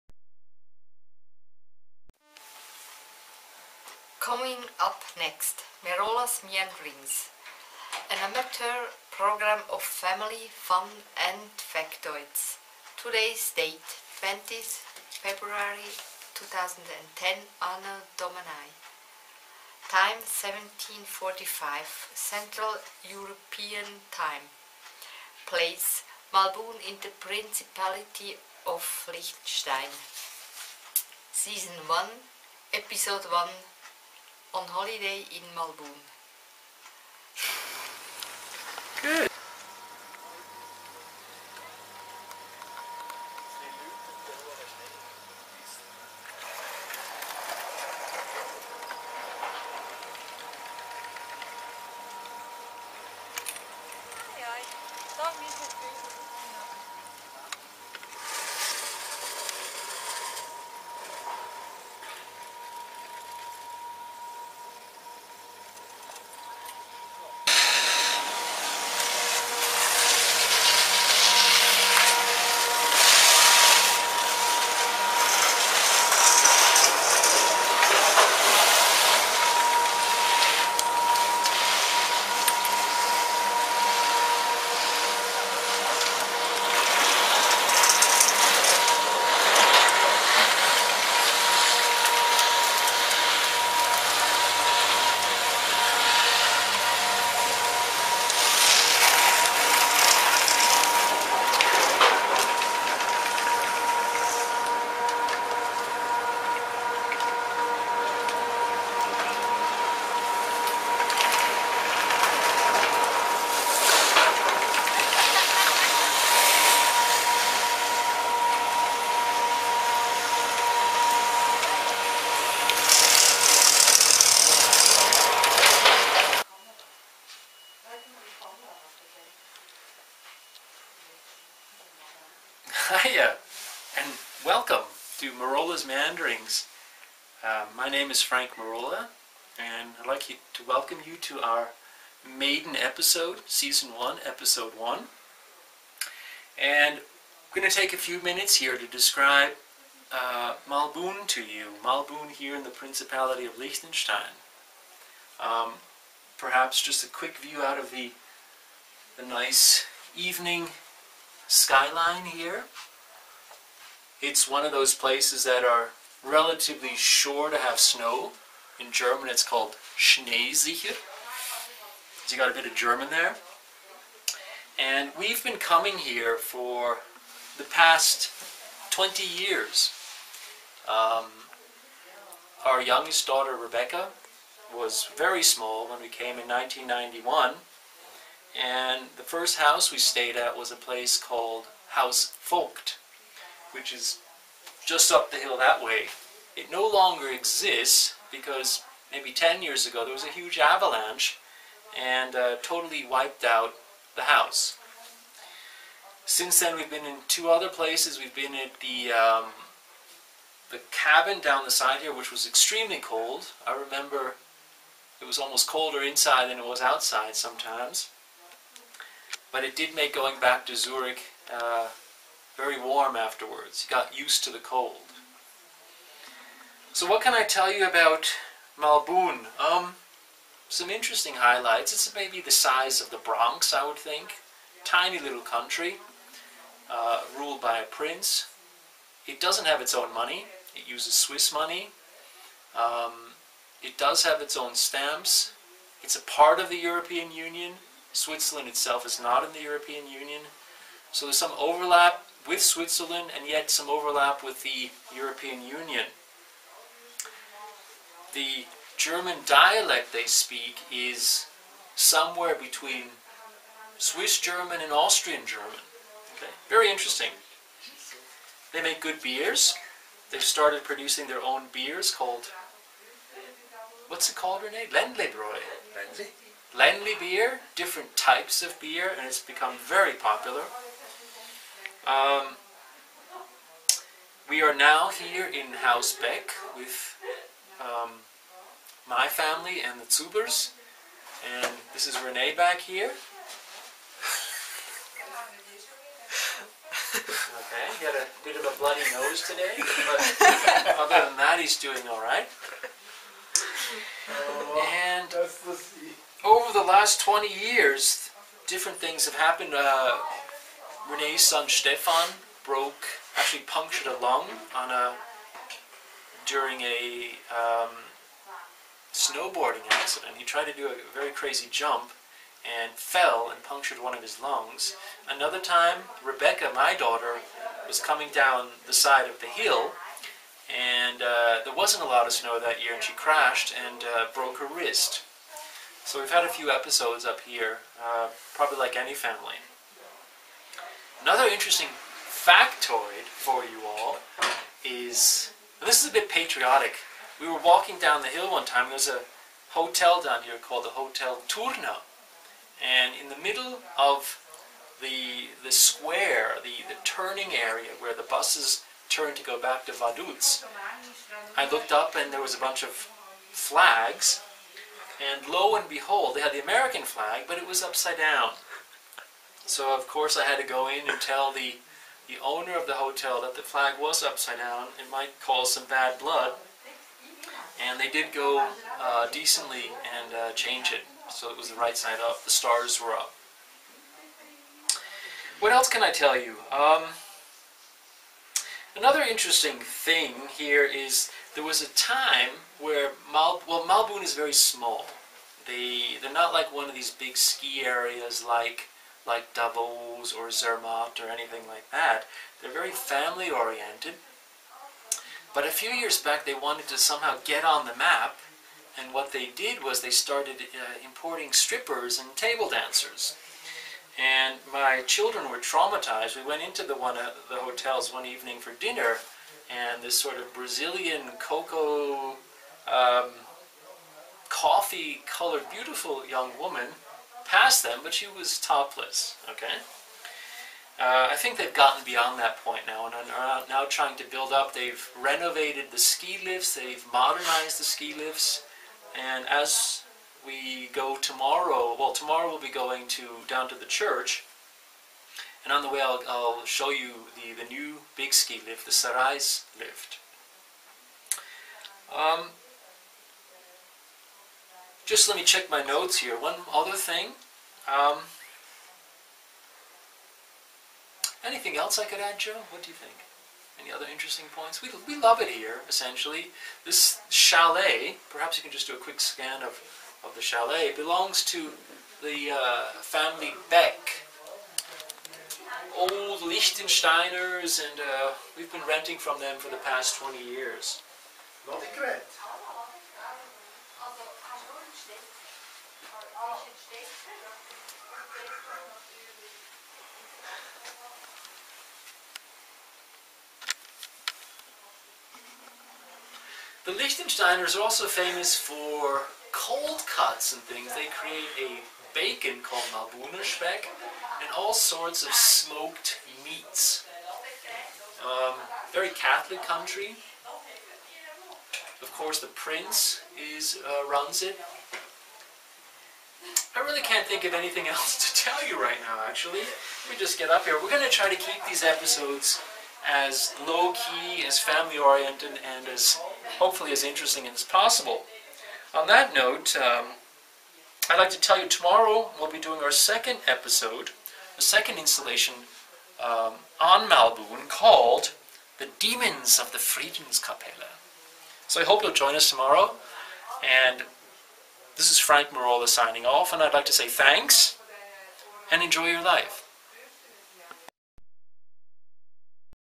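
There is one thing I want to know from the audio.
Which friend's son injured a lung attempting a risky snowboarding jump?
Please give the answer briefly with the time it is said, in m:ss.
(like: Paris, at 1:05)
Stefan, at 5:11.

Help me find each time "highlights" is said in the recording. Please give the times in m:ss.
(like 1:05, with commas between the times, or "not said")
3:51.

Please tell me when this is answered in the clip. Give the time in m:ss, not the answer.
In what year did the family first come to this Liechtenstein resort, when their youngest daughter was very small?
3:06.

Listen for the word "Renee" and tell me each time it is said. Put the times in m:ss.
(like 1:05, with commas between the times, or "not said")
4:34, 4:52, 5:11.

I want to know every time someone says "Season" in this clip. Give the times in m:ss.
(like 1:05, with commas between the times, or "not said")
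0:31, 2:23.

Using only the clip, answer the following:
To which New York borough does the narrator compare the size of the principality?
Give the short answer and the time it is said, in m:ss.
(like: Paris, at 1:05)
The Bronx, at 3:53.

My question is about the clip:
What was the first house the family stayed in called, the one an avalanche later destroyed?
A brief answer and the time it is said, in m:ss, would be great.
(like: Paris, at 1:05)
Haus Vogt, at 3:11.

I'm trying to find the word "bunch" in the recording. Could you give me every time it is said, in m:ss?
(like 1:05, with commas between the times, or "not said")
6:02.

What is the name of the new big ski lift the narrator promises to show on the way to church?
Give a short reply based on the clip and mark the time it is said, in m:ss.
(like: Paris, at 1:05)
Sareis lift, at 7:28.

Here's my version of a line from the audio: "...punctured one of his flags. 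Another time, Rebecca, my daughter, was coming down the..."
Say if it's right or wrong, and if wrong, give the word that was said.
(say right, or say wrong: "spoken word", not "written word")
wrong: "lungs", not "flags".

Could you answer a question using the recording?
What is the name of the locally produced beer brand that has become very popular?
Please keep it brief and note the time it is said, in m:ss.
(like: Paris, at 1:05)
Ländlebräu, at 4:34.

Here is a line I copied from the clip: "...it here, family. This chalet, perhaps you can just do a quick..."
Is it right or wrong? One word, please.
wrong.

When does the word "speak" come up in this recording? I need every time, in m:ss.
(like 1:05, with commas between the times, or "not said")
4:20.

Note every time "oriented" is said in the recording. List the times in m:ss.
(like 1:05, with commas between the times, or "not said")
6:43, 8:44.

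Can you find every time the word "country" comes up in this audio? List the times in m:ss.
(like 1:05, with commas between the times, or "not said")
3:55, 8:29.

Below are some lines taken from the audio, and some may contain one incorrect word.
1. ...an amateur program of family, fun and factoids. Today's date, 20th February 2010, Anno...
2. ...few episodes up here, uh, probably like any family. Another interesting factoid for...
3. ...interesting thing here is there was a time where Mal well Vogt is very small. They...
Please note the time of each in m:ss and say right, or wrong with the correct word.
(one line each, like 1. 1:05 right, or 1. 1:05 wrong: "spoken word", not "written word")
1. 0:08 right
2. 5:36 right
3. 6:29 wrong: "Malbun", not "Vogt".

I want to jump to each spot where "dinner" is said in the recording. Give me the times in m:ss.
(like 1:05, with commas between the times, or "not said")
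6:58.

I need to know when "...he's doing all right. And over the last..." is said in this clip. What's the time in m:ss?
5:01.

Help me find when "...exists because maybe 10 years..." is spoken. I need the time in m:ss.
3:17.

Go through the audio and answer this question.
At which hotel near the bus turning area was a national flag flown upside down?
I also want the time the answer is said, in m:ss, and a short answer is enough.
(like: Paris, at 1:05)
Hotel Turna, at 5:50.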